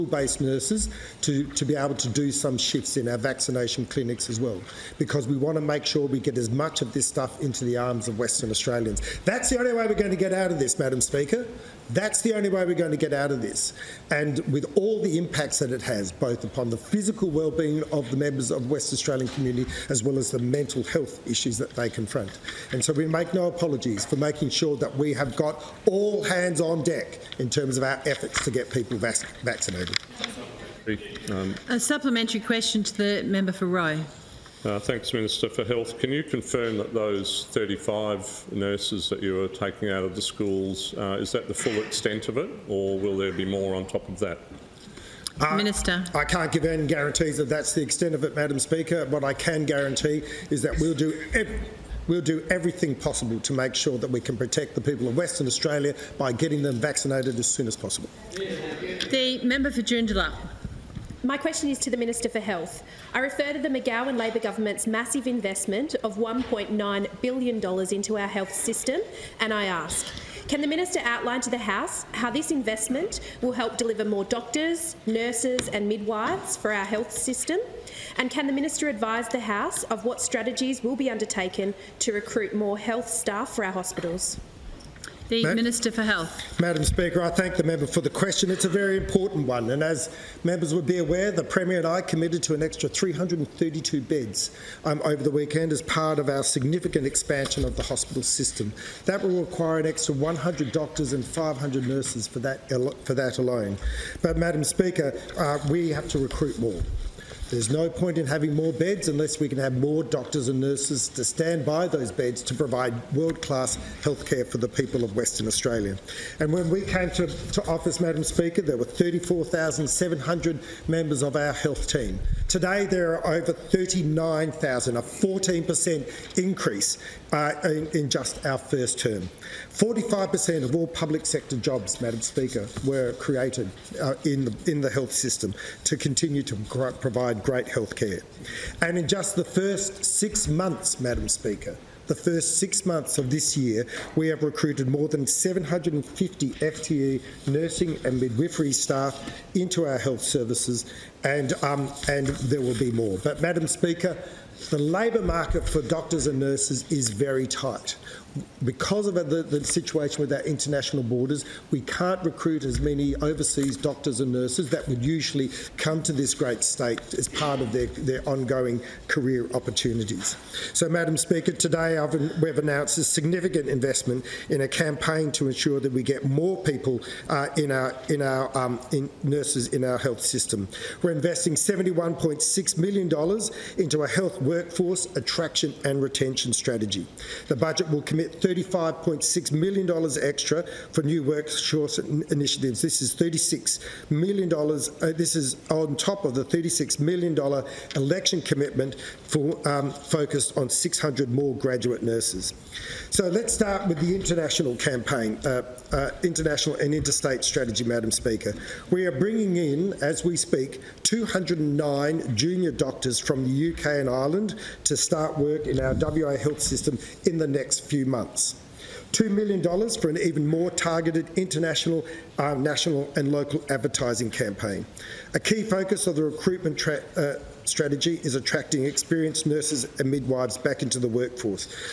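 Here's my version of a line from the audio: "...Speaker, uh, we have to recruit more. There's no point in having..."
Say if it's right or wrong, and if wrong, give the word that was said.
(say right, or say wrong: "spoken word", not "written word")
right.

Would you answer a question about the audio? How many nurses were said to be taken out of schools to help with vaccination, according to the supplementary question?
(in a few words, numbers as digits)
35.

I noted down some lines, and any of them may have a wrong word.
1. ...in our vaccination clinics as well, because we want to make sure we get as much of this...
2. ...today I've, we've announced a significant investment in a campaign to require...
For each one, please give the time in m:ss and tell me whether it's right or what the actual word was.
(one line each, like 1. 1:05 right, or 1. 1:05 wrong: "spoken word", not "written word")
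1. 0:02 right
2. 2:51 wrong: "ensure", not "require".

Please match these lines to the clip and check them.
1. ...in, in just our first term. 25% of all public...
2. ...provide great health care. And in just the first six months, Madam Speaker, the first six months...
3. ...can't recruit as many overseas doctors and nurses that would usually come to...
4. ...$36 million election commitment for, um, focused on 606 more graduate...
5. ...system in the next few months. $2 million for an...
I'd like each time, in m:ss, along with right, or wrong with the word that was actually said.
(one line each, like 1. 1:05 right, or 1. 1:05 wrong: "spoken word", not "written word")
1. 2:07 wrong: "45", not "25"
2. 2:16 right
3. 2:41 right
4. 3:16 wrong: "600", not "606"
5. 3:36 right.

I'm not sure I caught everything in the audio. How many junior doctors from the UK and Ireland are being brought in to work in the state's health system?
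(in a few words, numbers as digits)
209.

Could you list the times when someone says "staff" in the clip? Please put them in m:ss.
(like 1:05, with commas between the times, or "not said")
1:23, 2:28.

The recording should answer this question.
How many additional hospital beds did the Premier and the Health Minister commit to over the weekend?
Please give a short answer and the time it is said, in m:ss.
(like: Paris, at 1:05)
332, at 1:32.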